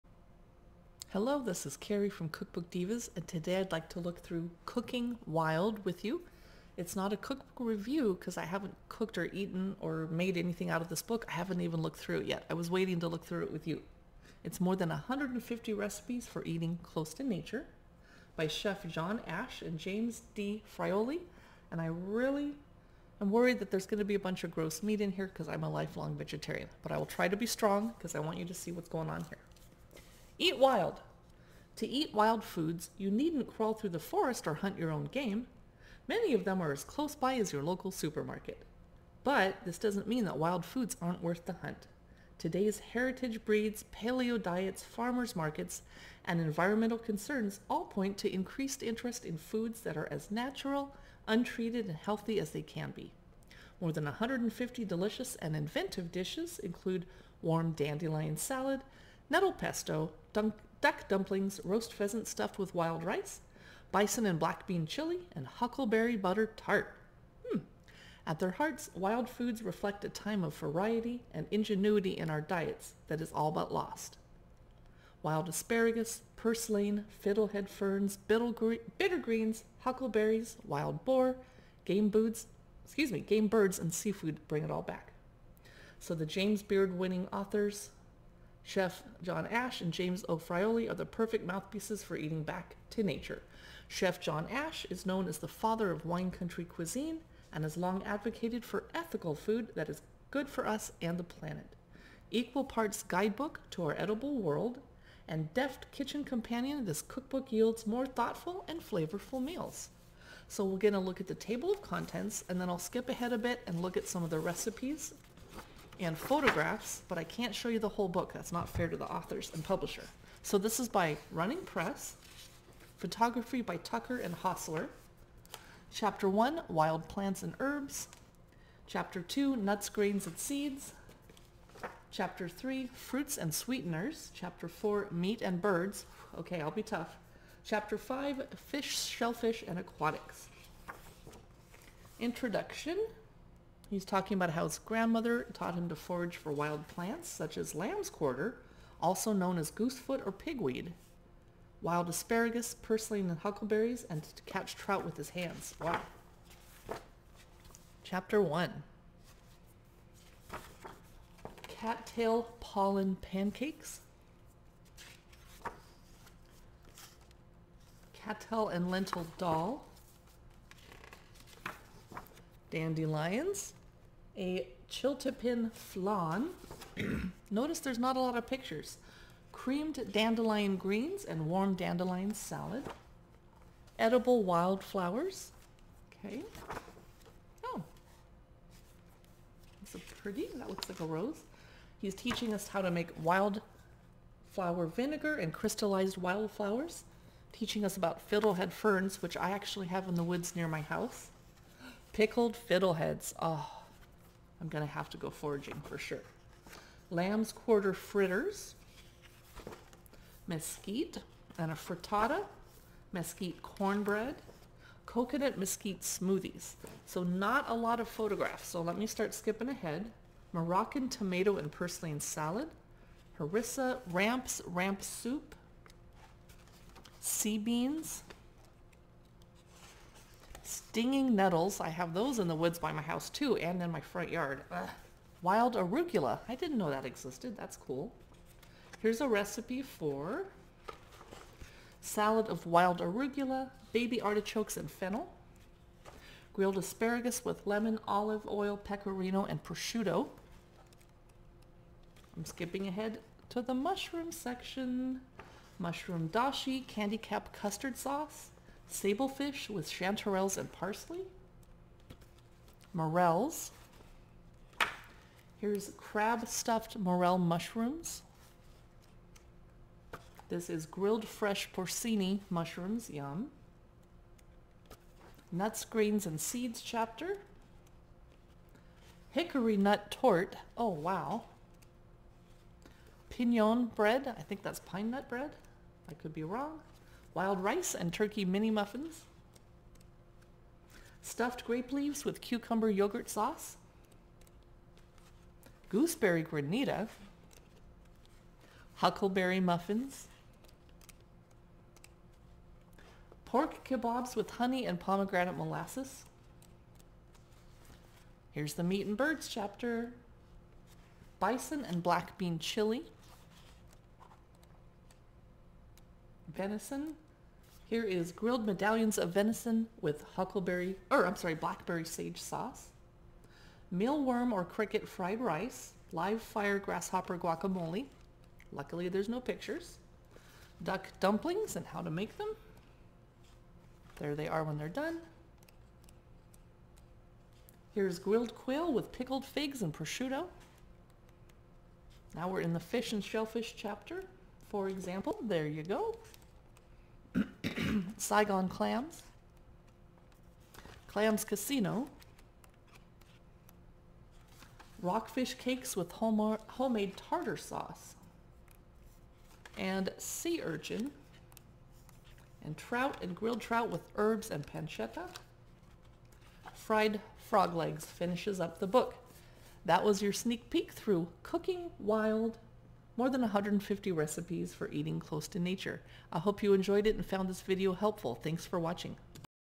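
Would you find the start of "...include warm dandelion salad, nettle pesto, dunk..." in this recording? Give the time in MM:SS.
00:56.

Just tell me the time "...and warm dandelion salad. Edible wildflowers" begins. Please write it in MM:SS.
03:01.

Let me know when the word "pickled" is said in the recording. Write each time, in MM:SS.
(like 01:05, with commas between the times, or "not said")
03:22, 05:39.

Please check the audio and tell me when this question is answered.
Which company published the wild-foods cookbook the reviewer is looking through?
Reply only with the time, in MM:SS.
02:01.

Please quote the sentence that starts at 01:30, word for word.
are the perfect mouthpieces for eating back to nature.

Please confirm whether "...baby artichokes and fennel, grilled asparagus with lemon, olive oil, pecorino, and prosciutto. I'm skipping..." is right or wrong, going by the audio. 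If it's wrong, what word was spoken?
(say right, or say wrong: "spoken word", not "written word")
right.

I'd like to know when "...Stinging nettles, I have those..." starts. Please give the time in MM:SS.
03:50.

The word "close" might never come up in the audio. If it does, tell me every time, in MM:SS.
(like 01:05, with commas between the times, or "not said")
00:16, 00:36, 06:15.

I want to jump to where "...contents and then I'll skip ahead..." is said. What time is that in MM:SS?
01:51.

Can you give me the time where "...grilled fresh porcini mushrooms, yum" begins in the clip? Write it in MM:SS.
04:30.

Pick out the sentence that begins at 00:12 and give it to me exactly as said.
I was waiting to look through it with you.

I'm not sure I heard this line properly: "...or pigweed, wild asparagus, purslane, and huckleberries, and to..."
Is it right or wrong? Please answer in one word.
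right.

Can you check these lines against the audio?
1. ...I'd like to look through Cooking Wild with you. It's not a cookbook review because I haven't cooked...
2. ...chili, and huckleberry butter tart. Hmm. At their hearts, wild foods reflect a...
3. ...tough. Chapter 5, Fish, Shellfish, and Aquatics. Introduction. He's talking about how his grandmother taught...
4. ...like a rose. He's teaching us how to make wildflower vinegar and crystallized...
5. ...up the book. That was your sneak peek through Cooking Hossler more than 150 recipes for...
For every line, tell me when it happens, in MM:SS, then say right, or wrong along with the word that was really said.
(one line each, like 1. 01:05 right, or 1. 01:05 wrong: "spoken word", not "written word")
1. 00:03 right
2. 01:04 right
3. 02:16 right
4. 03:10 right
5. 06:08 wrong: "Wild", not "Hossler".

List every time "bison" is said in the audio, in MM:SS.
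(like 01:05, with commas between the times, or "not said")
01:03, 05:11.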